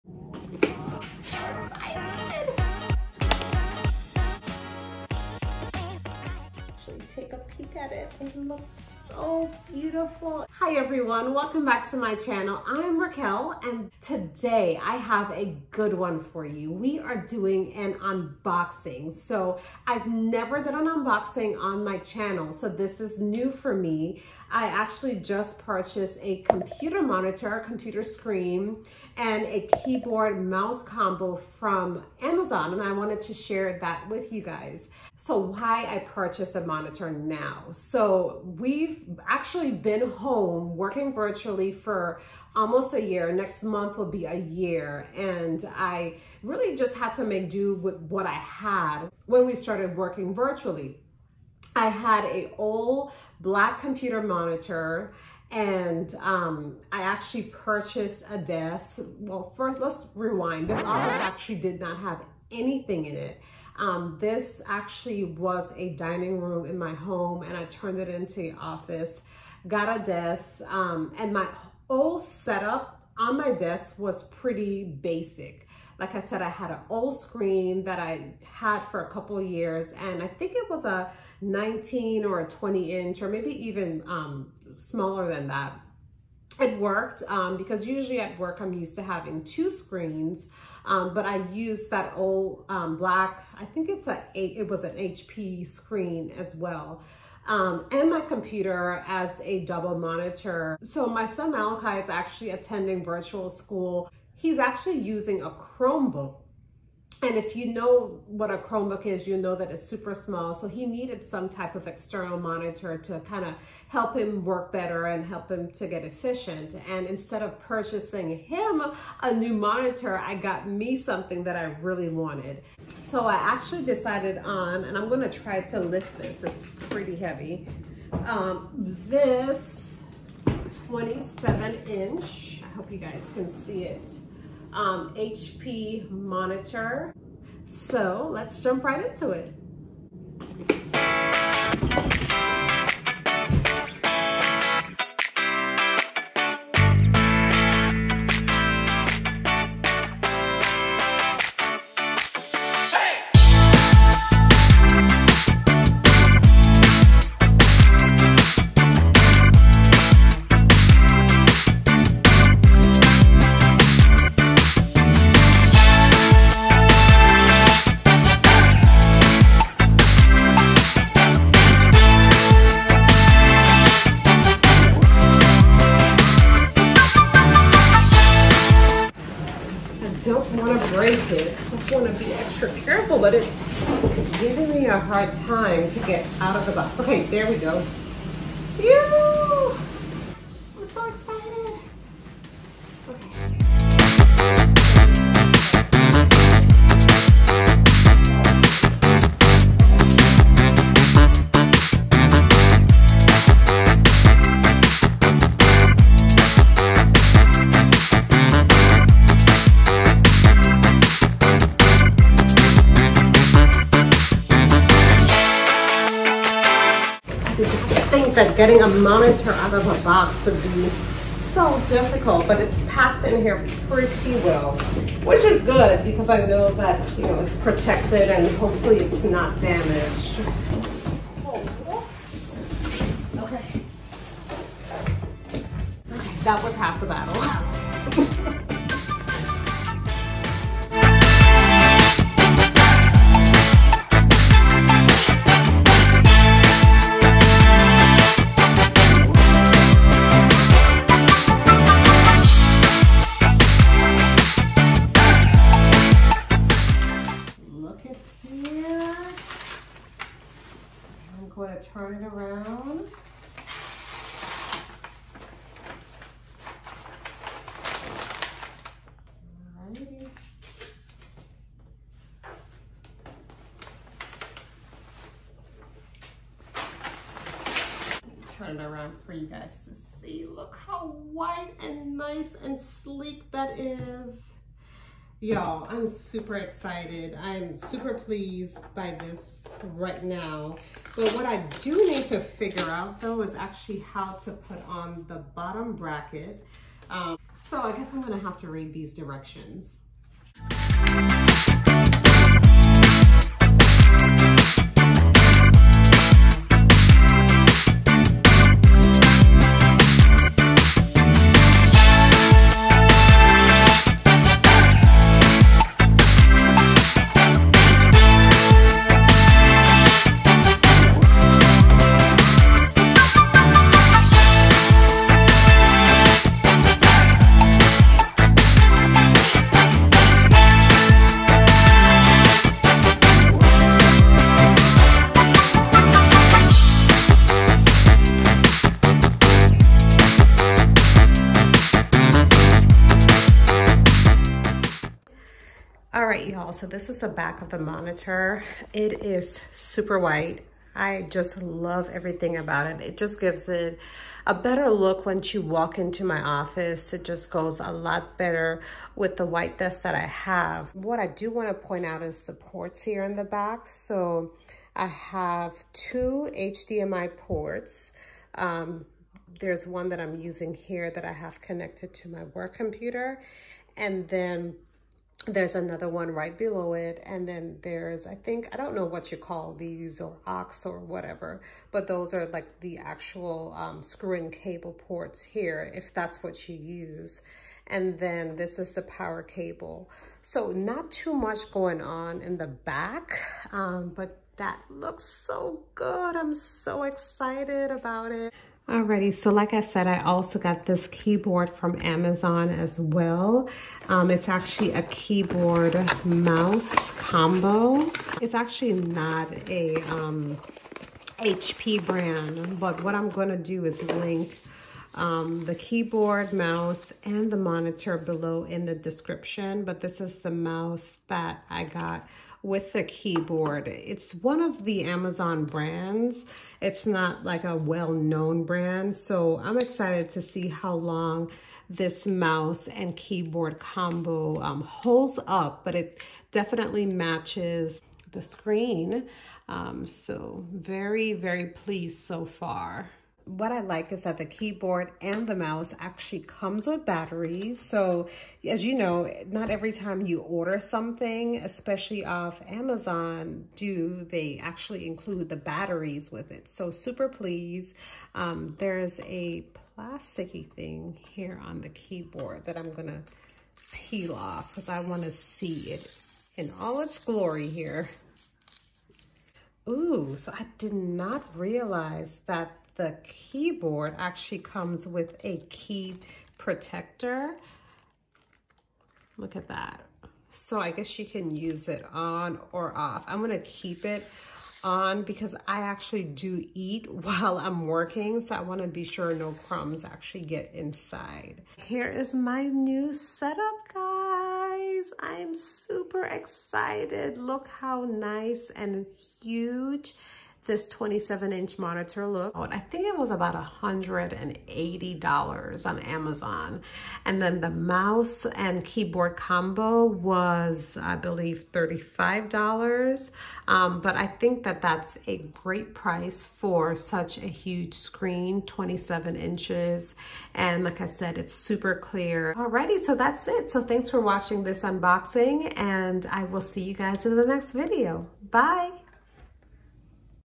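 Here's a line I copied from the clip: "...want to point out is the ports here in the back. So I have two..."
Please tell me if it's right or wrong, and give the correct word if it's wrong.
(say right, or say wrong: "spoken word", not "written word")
right.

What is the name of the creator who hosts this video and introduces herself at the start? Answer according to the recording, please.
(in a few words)
Raquel.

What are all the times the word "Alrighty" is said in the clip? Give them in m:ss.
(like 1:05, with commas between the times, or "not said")
6:38, 8:42.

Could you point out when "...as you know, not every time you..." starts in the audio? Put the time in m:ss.
7:28.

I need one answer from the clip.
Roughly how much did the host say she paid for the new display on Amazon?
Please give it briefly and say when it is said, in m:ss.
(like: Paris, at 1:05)
$180, at 8:23.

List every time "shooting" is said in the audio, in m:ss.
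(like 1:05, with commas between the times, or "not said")
not said.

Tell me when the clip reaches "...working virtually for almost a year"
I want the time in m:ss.
0:40.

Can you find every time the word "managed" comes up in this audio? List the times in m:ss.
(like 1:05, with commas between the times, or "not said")
not said.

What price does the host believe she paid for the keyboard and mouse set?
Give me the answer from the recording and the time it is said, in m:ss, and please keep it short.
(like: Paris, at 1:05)
$35, at 8:31.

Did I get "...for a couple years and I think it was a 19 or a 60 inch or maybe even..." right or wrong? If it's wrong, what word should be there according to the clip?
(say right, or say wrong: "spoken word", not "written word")
wrong: "20", not "60".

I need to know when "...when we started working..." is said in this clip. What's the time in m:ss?
0:49.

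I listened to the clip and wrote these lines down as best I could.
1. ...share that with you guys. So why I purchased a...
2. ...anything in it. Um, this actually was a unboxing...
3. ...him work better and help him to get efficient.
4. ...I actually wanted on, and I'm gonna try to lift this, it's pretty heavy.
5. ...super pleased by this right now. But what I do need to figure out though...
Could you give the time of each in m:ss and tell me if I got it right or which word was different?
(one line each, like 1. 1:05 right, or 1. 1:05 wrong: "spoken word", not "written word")
1. 0:33 right
2. 1:02 wrong: "dining", not "unboxing"
3. 1:54 right
4. 2:03 wrong: "decided", not "wanted"
5. 4:47 right.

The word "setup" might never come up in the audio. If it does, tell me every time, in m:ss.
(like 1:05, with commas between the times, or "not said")
1:12, 8:13.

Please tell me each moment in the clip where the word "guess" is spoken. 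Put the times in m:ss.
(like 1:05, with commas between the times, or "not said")
4:57, 8:00.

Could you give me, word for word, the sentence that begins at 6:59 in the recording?
But this is the mouse that I got with the keyboard.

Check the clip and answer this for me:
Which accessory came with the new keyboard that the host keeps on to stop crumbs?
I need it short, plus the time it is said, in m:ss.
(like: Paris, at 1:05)
Key protector, at 7:55.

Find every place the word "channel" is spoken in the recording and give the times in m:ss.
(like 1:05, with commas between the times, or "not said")
0:12, 0:21.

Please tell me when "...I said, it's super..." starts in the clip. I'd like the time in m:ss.
8:41.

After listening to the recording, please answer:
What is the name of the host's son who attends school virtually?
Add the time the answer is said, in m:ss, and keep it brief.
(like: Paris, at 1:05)
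Malachi, at 1:41.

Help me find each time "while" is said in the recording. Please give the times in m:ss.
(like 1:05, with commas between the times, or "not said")
8:07.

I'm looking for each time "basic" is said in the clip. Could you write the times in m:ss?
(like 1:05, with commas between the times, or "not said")
1:14.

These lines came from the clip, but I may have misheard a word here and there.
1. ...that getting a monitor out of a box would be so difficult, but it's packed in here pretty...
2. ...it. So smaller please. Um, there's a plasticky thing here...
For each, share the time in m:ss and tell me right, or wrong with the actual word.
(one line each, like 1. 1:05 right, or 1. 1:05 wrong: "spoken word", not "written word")
1. 3:38 right
2. 7:36 wrong: "super", not "smaller".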